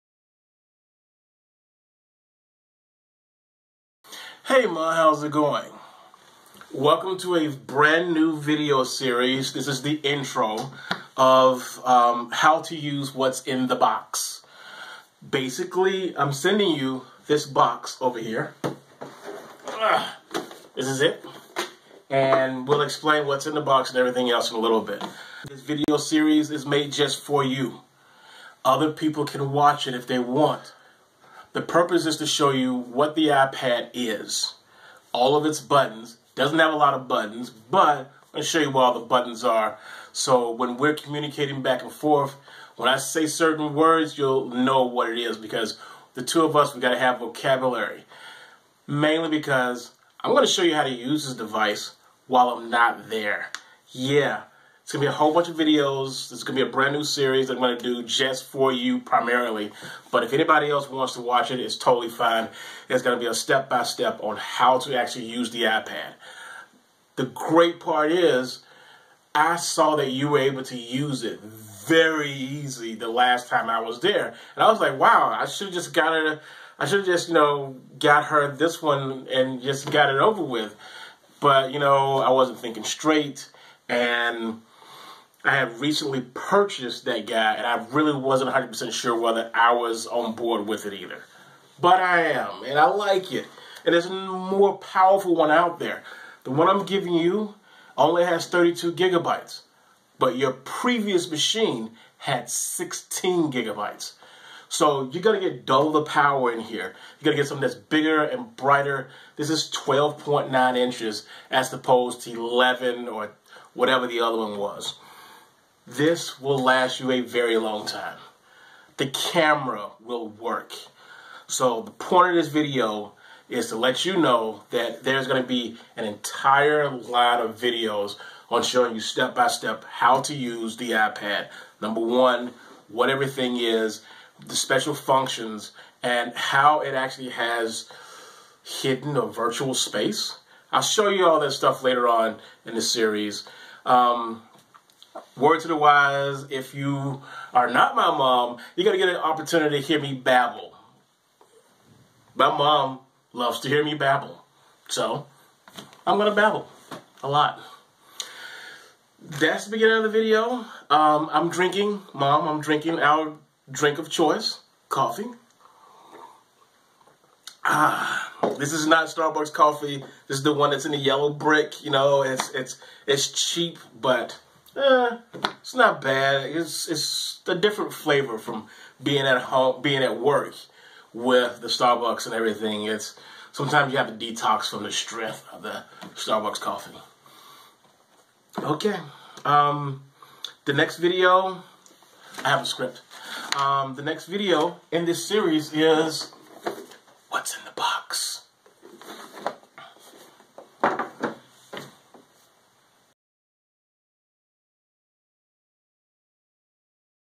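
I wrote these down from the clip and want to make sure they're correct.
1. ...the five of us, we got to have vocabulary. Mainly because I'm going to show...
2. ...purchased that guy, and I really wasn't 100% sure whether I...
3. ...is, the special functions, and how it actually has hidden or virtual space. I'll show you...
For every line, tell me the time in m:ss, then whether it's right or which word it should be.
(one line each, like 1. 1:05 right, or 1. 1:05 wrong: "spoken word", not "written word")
1. 0:46 wrong: "two", not "five"
2. 1:26 right
3. 2:13 right.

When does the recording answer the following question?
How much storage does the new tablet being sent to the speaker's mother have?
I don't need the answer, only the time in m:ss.
1:38.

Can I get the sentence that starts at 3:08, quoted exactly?
Okay, um, the next video, I have a script.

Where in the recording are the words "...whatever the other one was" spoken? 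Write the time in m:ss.
1:53.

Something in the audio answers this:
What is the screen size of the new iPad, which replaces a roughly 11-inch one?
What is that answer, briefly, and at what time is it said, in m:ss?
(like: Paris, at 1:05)
12.9 inches, at 1:49.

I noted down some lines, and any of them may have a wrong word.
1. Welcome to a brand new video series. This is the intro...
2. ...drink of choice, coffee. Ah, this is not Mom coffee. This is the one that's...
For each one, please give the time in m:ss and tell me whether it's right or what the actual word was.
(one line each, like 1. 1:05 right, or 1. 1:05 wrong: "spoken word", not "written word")
1. 0:06 right
2. 2:43 wrong: "Starbucks", not "Mom".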